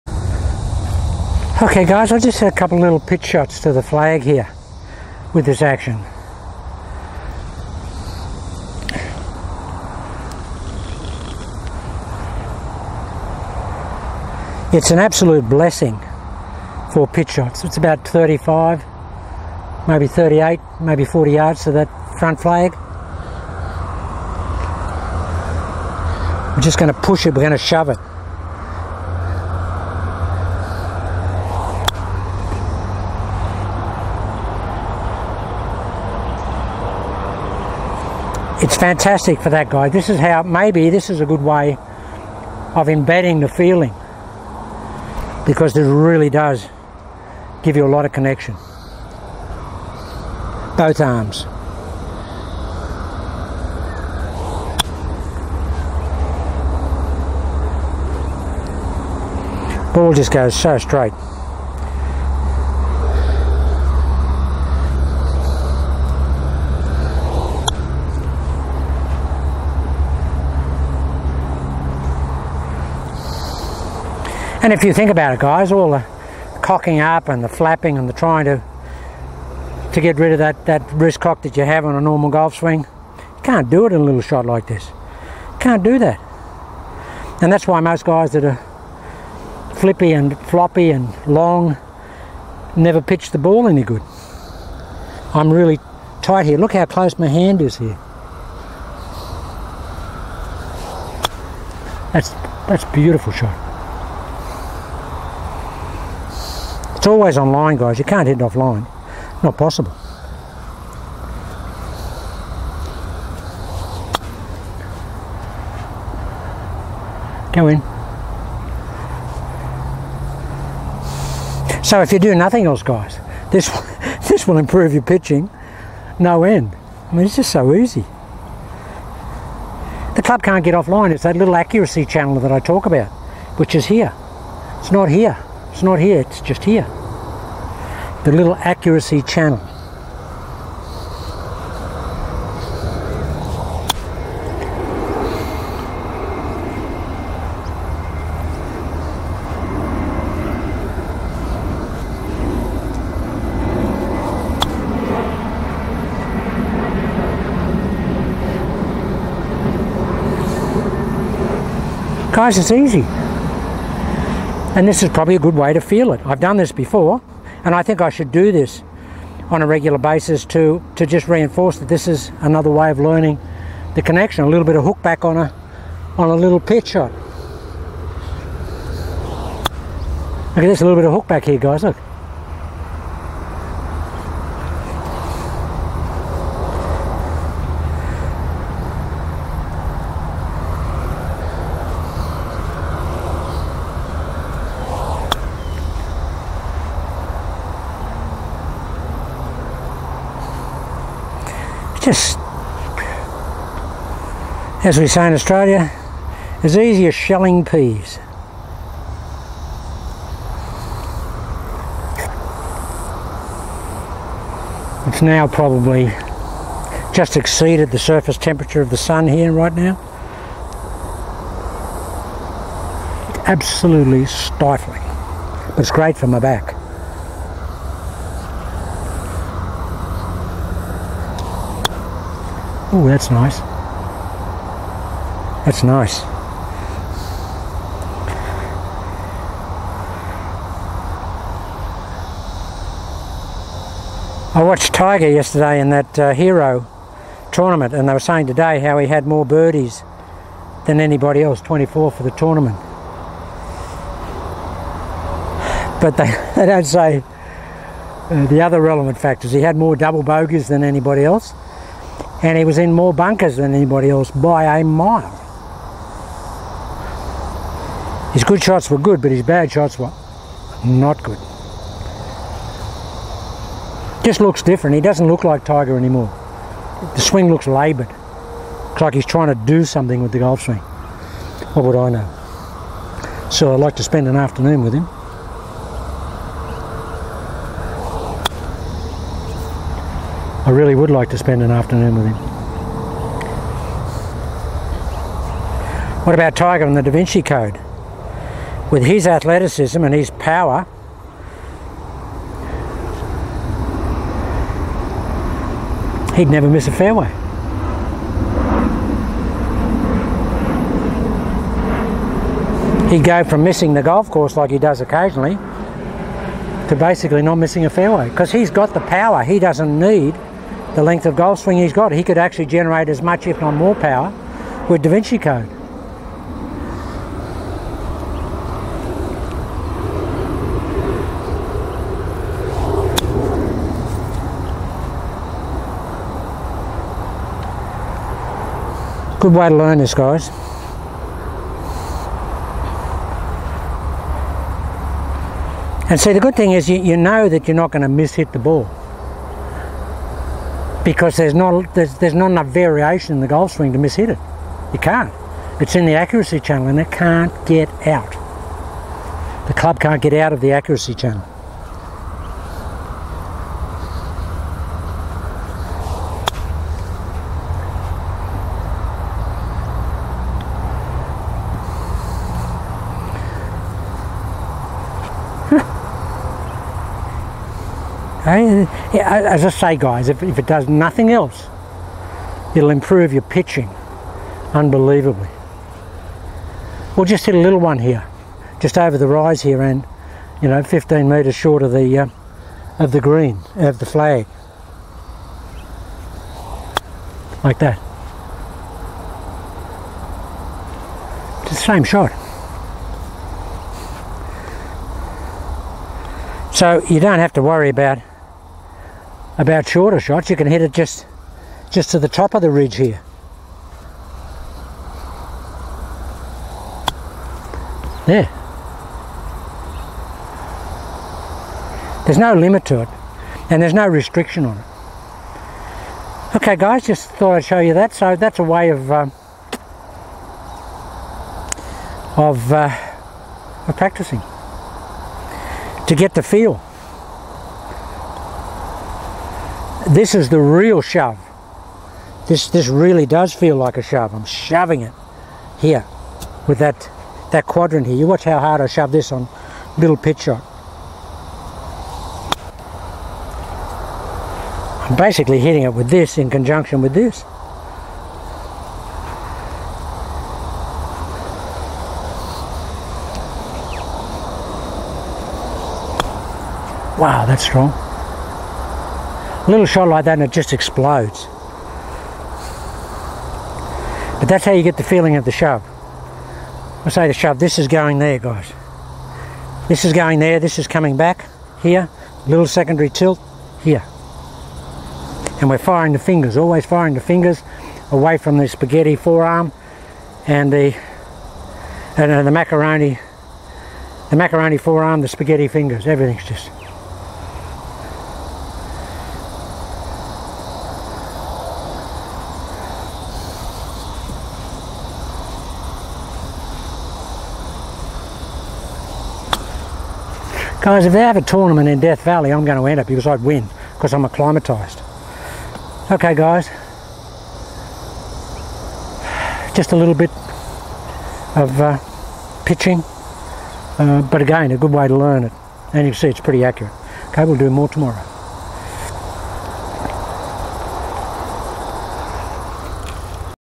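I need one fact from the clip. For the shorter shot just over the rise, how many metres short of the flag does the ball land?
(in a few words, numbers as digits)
15 metres.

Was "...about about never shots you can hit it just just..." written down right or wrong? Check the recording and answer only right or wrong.
wrong.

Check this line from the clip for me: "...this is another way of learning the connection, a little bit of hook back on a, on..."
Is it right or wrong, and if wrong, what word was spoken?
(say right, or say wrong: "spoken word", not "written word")
right.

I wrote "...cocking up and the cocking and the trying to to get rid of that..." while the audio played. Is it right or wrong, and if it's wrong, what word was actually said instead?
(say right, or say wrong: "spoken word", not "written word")
wrong: "flapping", not "cocking".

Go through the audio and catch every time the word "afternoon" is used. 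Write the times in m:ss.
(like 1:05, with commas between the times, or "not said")
4:44, 4:51.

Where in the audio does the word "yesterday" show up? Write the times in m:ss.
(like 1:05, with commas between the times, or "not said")
4:05.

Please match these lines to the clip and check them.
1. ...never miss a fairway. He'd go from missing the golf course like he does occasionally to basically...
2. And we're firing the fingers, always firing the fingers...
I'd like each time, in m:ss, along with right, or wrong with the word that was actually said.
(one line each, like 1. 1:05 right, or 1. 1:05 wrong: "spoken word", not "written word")
1. 5:06 right
2. 8:05 right.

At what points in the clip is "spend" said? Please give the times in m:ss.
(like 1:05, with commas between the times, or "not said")
4:44, 4:51.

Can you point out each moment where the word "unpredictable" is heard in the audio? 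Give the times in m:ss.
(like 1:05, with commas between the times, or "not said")
not said.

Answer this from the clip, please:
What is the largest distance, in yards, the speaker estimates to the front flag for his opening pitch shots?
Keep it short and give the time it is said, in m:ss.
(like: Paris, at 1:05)
40 yards, at 0:21.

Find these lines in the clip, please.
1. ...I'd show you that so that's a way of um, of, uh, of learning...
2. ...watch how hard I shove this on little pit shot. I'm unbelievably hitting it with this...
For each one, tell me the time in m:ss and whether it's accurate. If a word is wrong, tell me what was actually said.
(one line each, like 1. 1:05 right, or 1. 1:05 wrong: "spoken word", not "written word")
1. 7:07 wrong: "practicing", not "learning"
2. 7:28 wrong: "basically", not "unbelievably".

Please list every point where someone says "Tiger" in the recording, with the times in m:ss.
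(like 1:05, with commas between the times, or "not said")
4:04, 4:35, 4:56.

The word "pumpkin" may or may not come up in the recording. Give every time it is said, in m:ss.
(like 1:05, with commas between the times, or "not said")
not said.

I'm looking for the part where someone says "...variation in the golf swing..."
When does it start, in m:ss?
5:52.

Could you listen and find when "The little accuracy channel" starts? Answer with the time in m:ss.
2:18.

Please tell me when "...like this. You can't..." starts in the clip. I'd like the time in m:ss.
1:24.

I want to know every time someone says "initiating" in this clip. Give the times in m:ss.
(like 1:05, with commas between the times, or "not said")
not said.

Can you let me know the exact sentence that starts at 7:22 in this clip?
This, this really does feel like a shove.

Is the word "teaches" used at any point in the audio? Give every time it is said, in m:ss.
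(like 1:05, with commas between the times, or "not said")
not said.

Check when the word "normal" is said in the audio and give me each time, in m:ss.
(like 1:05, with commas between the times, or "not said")
1:22.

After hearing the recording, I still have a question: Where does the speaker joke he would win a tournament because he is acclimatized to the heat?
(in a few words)
Death Valley.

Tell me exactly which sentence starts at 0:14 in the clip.
It's an absolute blessing for pitch shots.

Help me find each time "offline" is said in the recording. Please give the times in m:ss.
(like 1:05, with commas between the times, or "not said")
1:48, 2:10.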